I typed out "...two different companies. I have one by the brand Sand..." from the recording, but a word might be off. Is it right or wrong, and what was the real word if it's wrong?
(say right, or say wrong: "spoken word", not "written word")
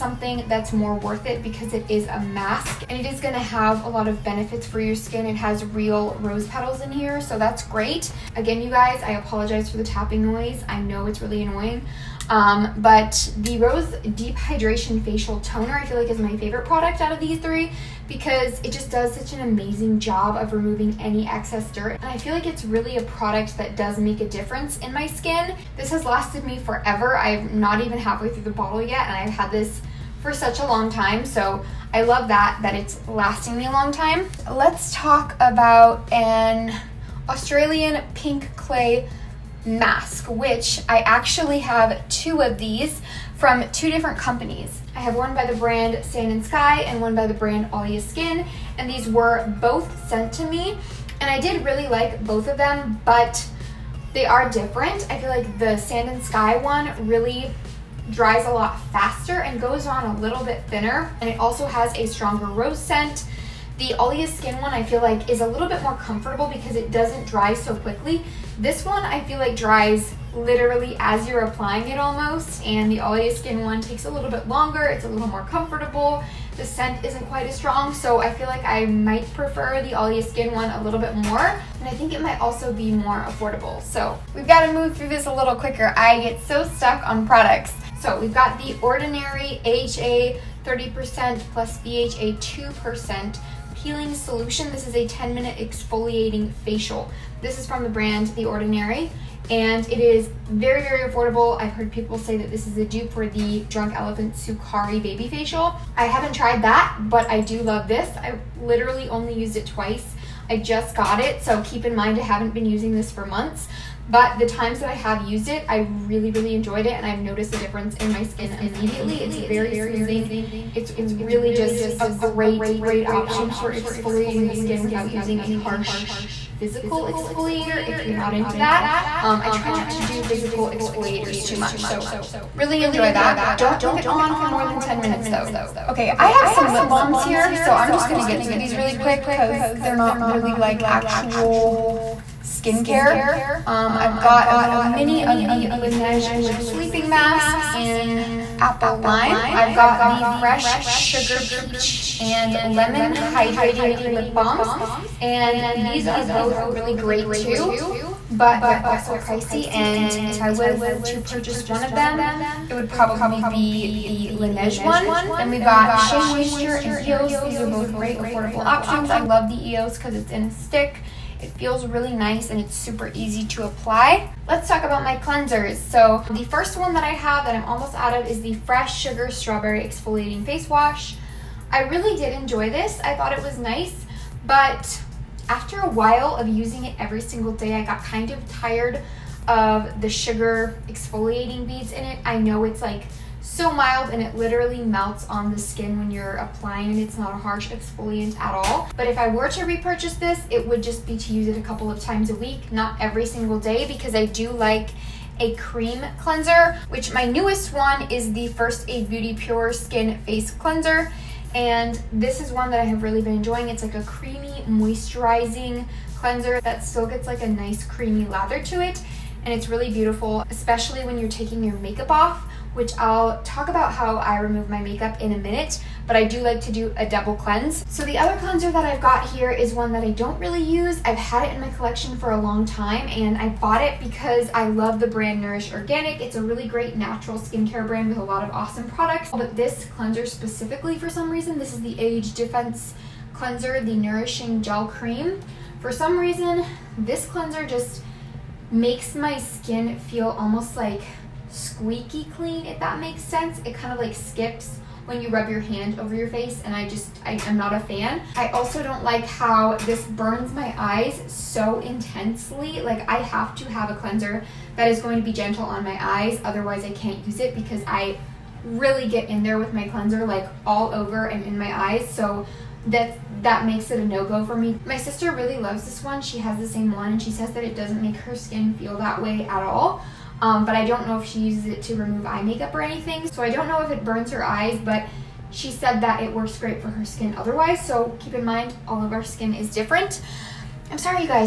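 right.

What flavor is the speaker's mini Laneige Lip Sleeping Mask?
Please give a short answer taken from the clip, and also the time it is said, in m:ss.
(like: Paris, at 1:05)
apple lime, at 2:28.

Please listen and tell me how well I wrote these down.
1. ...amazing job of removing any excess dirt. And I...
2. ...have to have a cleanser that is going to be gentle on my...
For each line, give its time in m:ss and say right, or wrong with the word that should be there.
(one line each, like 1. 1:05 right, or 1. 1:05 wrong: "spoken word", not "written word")
1. 0:19 right
2. 4:23 right.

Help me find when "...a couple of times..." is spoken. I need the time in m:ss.
3:21.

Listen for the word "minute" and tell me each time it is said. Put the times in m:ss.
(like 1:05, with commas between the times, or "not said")
1:35, 2:15, 3:45.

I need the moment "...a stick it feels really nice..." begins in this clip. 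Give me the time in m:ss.
2:50.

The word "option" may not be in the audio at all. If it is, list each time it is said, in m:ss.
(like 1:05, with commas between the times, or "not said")
2:03, 2:48.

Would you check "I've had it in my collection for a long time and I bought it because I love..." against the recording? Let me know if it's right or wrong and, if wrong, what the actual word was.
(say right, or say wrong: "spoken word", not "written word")
right.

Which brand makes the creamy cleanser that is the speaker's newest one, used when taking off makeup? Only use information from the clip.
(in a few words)
First Aid Beauty.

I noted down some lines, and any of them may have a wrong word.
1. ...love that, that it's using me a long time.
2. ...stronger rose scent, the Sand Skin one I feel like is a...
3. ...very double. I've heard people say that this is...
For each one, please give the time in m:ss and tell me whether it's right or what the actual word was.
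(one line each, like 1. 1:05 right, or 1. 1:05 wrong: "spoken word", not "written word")
1. 0:32 wrong: "lasting", not "using"
2. 1:02 wrong: "Alya", not "Sand"
3. 1:40 wrong: "affordable", not "double".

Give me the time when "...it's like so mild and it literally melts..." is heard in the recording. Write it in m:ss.
3:12.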